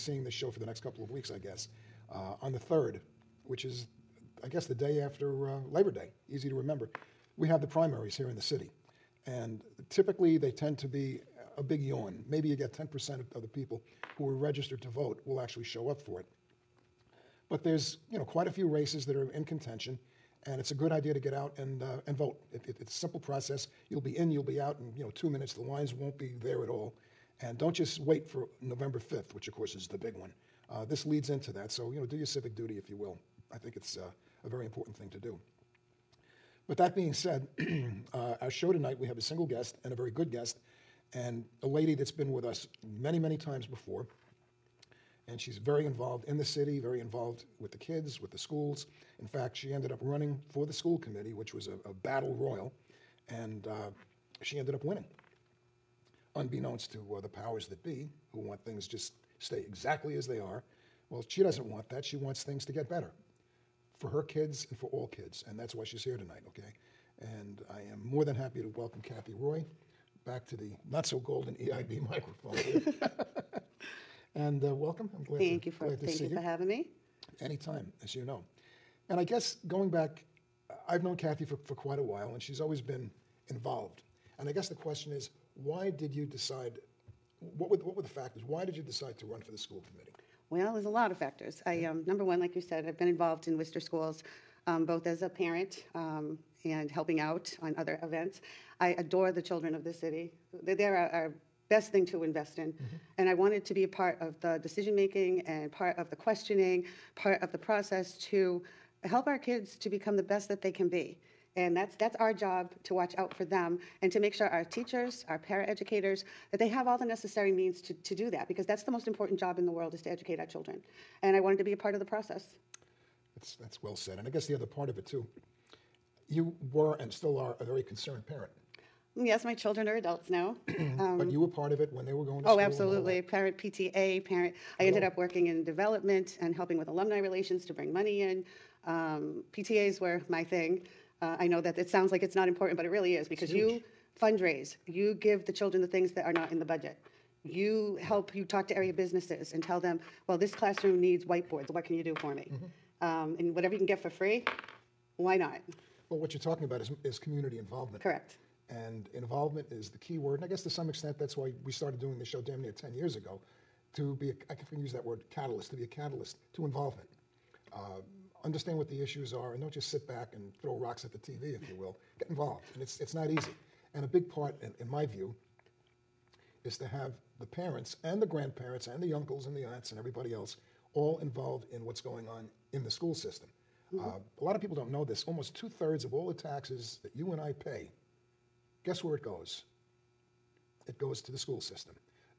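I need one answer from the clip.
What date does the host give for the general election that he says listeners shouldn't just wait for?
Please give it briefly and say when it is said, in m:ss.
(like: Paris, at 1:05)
November 5th, at 0:28.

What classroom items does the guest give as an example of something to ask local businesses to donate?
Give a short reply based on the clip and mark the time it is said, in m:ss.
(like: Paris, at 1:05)
whiteboards, at 2:31.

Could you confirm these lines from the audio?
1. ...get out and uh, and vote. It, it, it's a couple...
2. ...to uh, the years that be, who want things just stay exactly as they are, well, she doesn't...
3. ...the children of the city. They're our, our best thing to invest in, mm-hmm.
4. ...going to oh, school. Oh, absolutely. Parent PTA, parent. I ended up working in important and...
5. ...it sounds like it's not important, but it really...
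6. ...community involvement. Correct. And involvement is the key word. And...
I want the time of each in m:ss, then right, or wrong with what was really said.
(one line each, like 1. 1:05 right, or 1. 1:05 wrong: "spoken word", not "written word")
1. 0:21 wrong: "simple", not "couple"
2. 0:56 wrong: "powers", not "years"
3. 1:39 right
4. 2:12 wrong: "development", not "important"
5. 2:21 right
6. 2:37 right.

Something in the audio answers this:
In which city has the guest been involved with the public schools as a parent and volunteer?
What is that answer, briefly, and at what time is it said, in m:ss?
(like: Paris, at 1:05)
Worcester, at 1:33.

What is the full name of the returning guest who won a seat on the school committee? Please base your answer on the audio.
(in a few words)
Kathy Roy.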